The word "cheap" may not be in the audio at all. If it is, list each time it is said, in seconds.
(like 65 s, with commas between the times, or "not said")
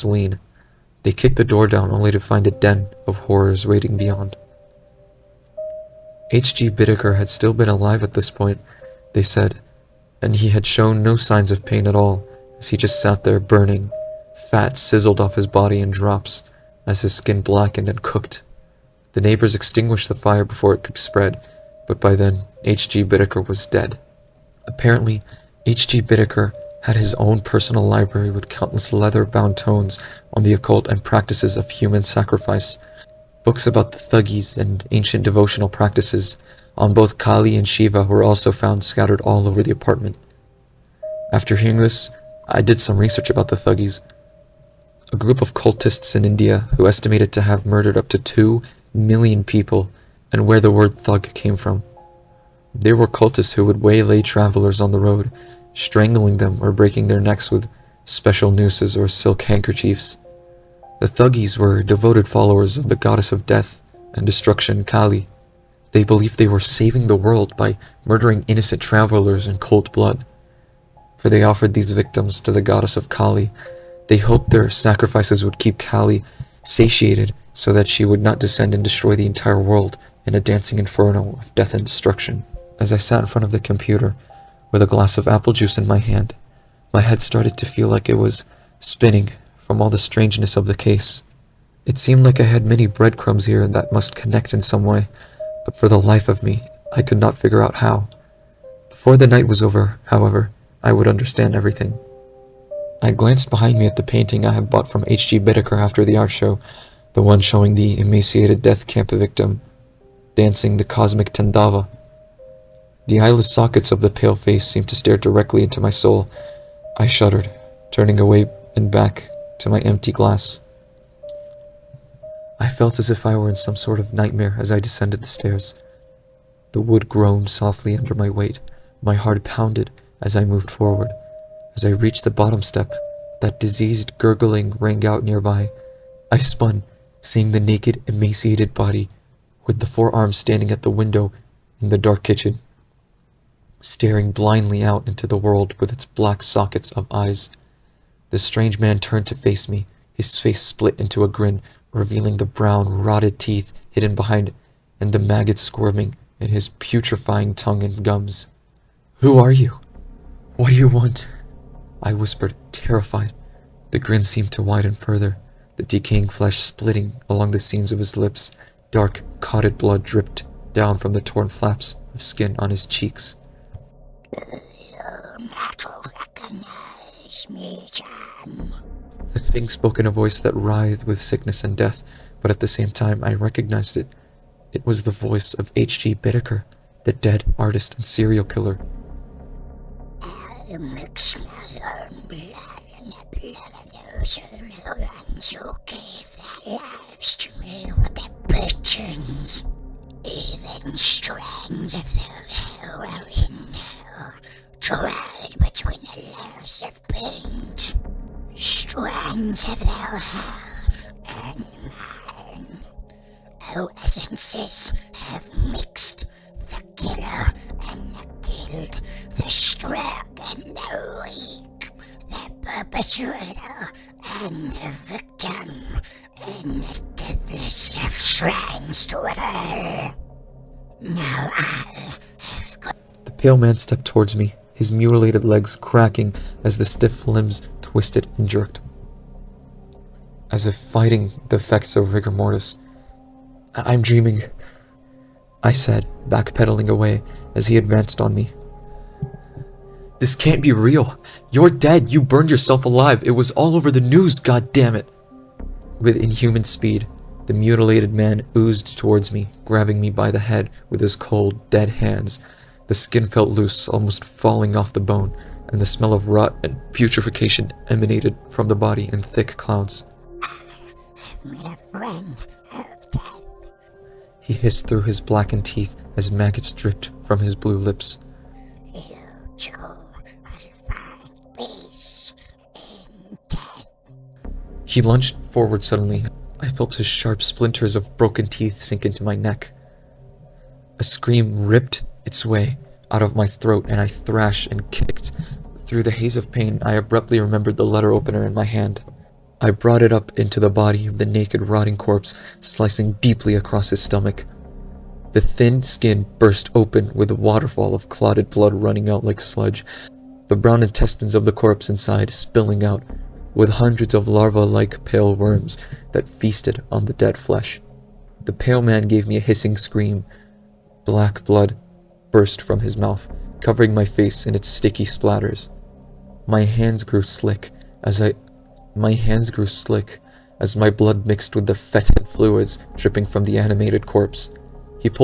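not said.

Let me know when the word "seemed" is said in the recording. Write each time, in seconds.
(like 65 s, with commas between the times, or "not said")
91 s, 114 s, 164 s.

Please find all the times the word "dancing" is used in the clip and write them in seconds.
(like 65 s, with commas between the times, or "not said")
80 s, 110 s.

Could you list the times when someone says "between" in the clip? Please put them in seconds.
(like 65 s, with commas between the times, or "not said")
205 s.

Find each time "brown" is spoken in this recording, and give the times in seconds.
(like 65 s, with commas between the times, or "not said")
152 s, 310 s.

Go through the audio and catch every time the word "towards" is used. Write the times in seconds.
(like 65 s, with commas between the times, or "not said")
234 s, 258 s.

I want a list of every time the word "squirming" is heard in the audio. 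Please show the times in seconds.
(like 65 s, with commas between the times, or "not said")
155 s.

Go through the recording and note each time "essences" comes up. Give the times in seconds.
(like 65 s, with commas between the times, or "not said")
213 s.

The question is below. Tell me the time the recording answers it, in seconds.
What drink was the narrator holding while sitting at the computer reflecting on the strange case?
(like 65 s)
85 s.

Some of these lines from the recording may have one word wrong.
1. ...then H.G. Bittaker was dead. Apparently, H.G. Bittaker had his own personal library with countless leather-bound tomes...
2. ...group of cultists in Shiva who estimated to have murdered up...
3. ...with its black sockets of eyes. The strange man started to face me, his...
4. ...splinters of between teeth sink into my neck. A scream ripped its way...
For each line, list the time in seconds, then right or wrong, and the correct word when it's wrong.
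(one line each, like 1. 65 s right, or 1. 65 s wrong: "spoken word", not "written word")
1. 22 s right
2. 45 s wrong: "India", not "Shiva"
3. 145 s wrong: "turned", not "started"
4. 287 s wrong: "broken", not "between".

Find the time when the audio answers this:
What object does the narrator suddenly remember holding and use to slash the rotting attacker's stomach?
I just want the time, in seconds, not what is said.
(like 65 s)
297 s.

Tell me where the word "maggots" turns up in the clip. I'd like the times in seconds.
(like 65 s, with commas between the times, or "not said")
155 s, 276 s.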